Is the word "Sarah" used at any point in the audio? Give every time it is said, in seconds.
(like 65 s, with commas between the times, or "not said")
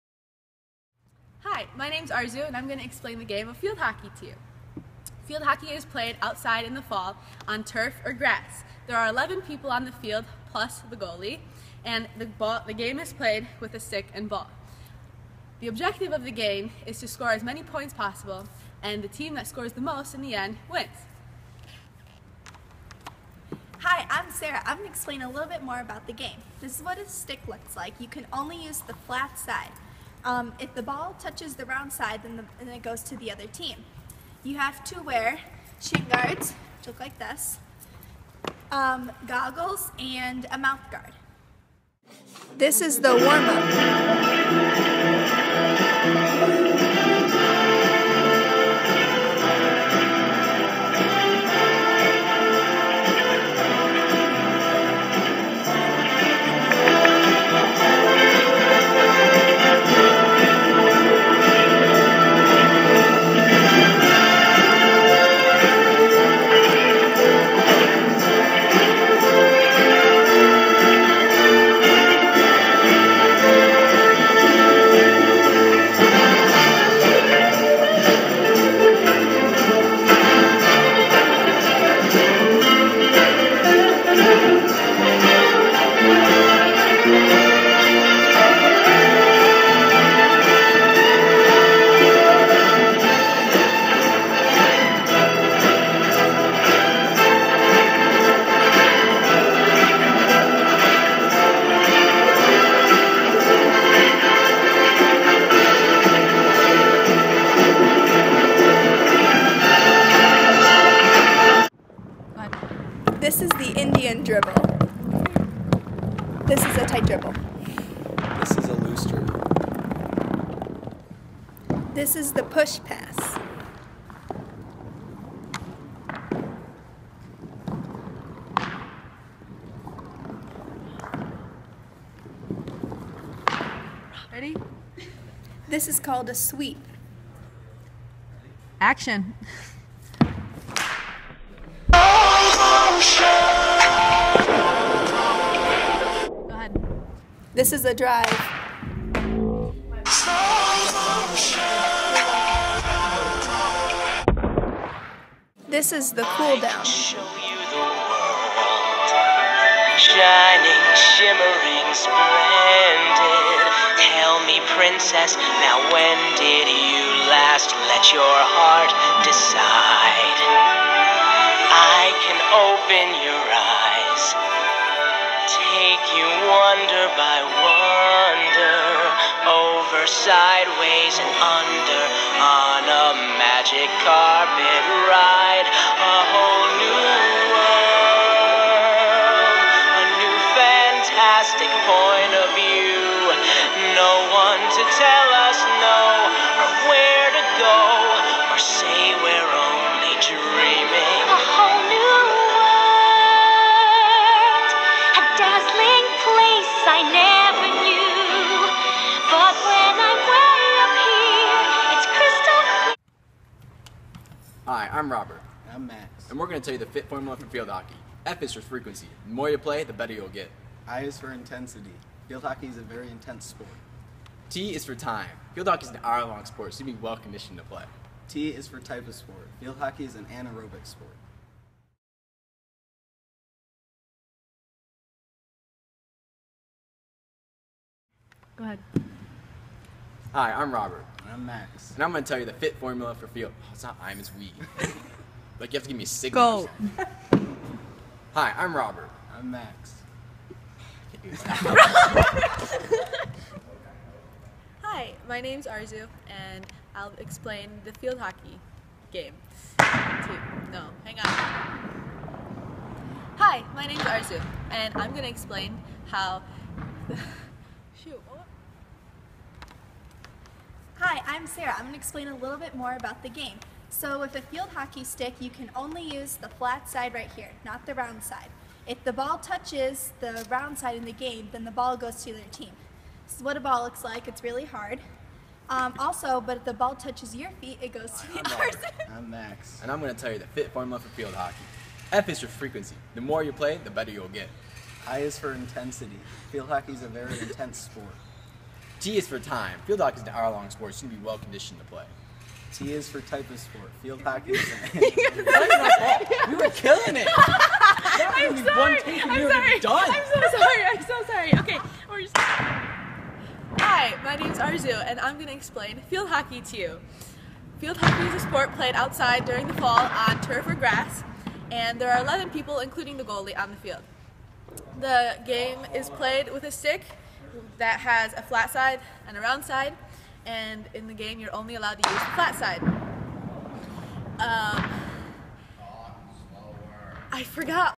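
24 s, 271 s.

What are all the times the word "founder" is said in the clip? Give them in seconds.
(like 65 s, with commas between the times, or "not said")
not said.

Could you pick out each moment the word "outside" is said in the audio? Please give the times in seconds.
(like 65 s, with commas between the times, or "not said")
6 s, 318 s.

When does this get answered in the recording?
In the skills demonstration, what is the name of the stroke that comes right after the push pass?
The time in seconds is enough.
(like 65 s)
136 s.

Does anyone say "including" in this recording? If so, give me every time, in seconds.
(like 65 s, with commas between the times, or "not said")
322 s.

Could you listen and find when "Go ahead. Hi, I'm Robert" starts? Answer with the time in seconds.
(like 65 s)
238 s.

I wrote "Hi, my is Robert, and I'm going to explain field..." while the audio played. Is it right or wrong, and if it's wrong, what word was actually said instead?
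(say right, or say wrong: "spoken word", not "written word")
wrong: "Arezu", not "Robert".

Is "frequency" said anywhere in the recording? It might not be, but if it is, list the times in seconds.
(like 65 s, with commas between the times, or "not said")
218 s, 292 s.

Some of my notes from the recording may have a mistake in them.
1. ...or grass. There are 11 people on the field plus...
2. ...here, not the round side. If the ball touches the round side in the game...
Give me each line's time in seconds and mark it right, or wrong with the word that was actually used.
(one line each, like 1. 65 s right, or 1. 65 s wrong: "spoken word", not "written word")
1. 8 s right
2. 277 s right.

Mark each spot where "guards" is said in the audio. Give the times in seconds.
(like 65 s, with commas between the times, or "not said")
36 s, 40 s.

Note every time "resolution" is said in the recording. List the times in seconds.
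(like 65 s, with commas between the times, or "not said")
not said.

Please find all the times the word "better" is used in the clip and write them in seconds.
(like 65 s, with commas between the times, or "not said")
219 s, 293 s.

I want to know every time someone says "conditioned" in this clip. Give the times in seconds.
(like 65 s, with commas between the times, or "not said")
227 s, 301 s.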